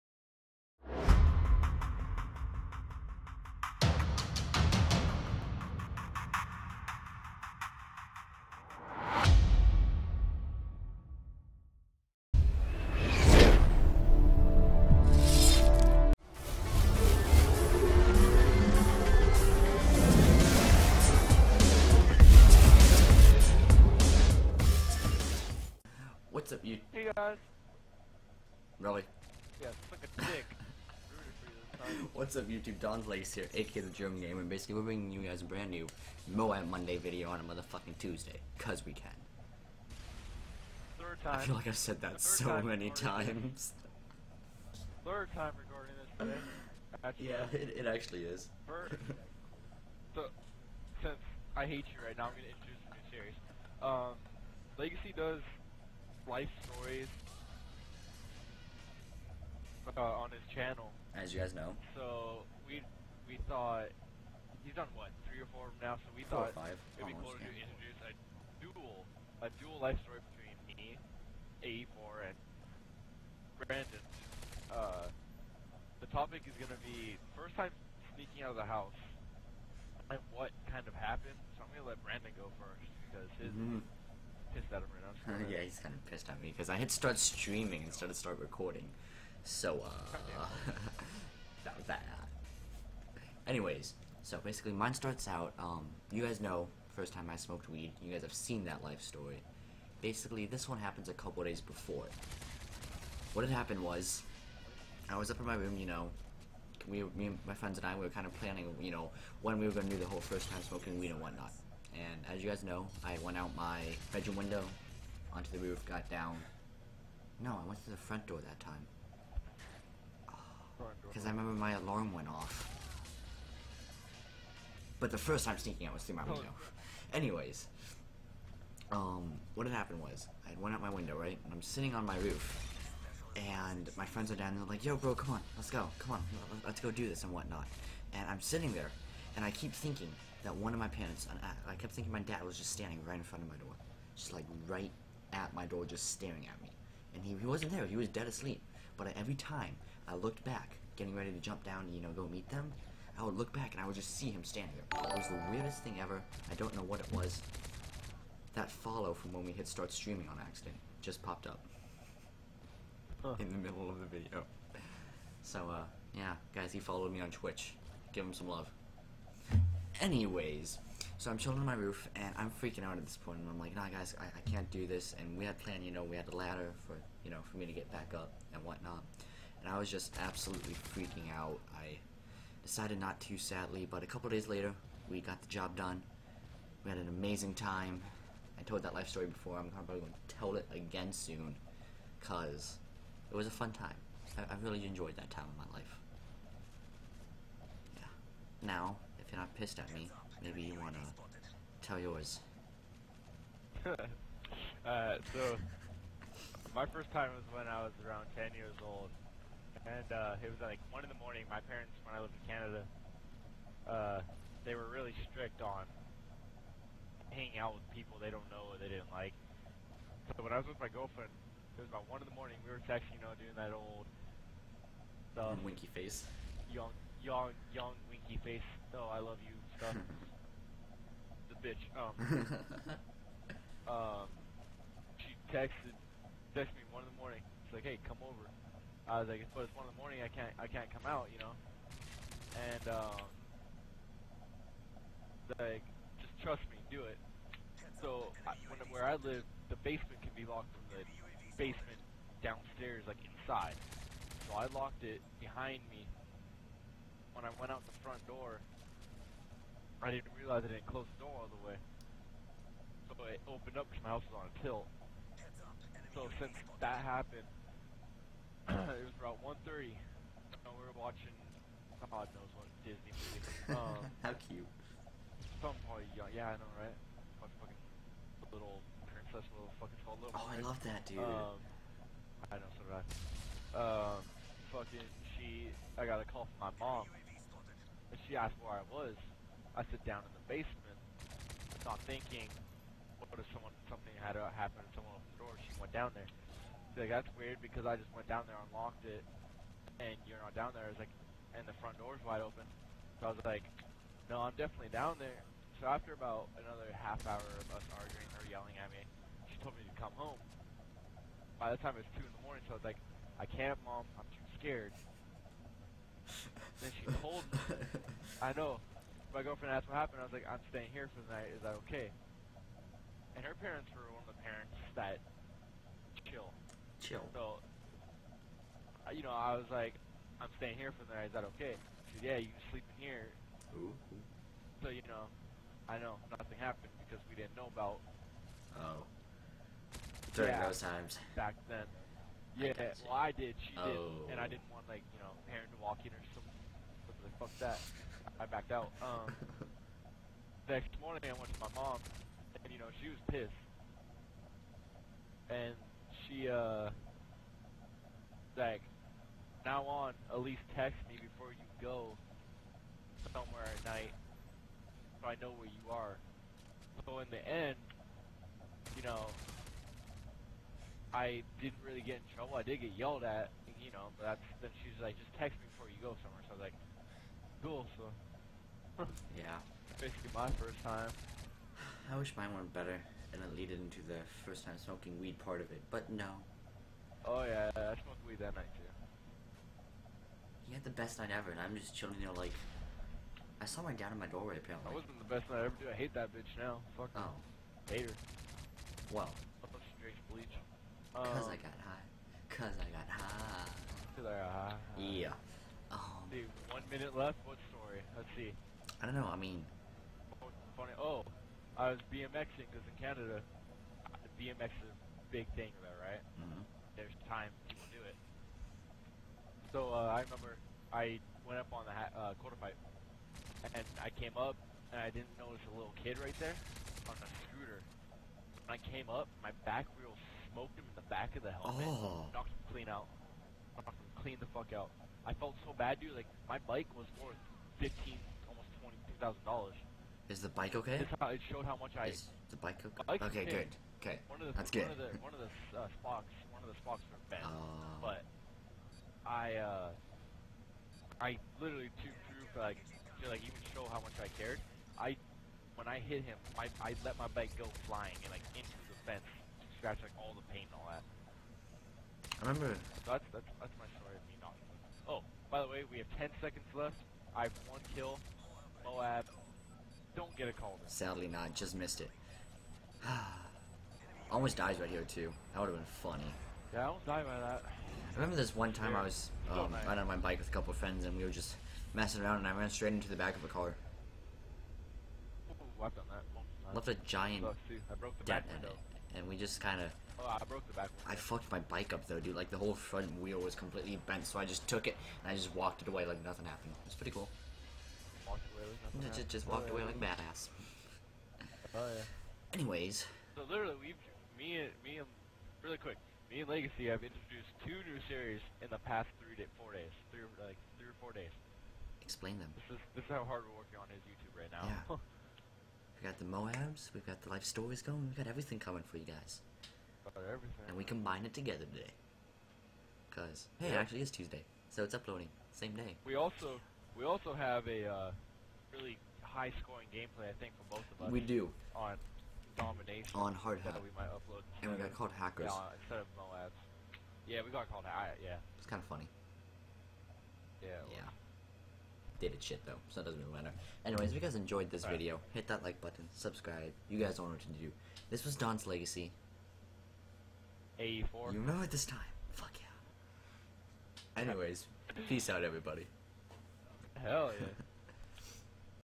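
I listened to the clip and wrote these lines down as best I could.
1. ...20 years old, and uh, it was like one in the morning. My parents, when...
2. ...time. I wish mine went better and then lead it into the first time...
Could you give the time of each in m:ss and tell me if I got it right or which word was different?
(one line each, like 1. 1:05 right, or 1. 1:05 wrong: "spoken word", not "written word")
1. 3:28 wrong: "10", not "20"
2. 6:20 right.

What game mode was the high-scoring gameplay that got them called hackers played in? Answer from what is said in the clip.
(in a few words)
Domination.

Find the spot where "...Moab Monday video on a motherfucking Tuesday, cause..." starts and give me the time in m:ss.
0:36.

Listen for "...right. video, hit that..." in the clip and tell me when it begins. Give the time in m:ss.
9:04.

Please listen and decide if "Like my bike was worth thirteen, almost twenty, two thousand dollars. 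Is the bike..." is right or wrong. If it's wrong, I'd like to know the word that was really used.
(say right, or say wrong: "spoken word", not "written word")
wrong: "fifteen", not "thirteen".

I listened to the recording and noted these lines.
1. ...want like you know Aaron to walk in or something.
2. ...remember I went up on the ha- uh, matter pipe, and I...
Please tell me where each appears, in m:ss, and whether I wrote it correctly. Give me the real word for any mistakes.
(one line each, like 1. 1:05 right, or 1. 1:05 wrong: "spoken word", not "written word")
1. 5:44 right
2. 7:00 wrong: "quarter", not "matter".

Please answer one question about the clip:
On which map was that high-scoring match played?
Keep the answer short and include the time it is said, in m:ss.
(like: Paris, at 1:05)
Hardhat, at 8:53.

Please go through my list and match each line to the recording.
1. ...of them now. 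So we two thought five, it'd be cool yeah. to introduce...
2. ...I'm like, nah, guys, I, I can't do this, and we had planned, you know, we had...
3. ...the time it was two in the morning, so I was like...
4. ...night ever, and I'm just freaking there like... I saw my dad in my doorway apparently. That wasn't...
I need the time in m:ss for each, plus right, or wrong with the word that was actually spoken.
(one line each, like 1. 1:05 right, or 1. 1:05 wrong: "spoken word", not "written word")
1. 1:05 wrong: "four", not "two"
2. 2:53 right
3. 5:11 right
4. 6:31 wrong: "chilling", not "freaking".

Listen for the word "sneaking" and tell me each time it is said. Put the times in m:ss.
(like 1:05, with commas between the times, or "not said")
1:18, 2:05.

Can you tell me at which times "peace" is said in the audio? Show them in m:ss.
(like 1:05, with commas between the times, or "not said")
9:15.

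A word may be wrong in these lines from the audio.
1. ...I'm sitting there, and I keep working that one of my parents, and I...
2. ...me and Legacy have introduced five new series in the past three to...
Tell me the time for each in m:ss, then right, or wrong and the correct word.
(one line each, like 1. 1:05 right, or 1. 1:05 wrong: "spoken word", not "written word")
1. 2:18 wrong: "thinking", not "working"
2. 8:26 wrong: "two", not "five".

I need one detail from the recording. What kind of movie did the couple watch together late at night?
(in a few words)
Disney movie.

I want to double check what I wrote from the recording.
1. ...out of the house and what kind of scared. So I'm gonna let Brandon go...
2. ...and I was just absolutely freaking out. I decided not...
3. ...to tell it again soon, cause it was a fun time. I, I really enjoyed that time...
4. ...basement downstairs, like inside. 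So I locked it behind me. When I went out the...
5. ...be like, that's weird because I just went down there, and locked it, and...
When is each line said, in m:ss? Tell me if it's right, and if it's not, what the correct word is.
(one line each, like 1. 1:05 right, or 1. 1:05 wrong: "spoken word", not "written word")
1. 1:18 wrong: "happened", not "scared"
2. 2:59 right
3. 3:10 right
4. 4:11 right
5. 4:56 right.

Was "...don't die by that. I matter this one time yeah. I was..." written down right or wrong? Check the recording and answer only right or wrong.
wrong.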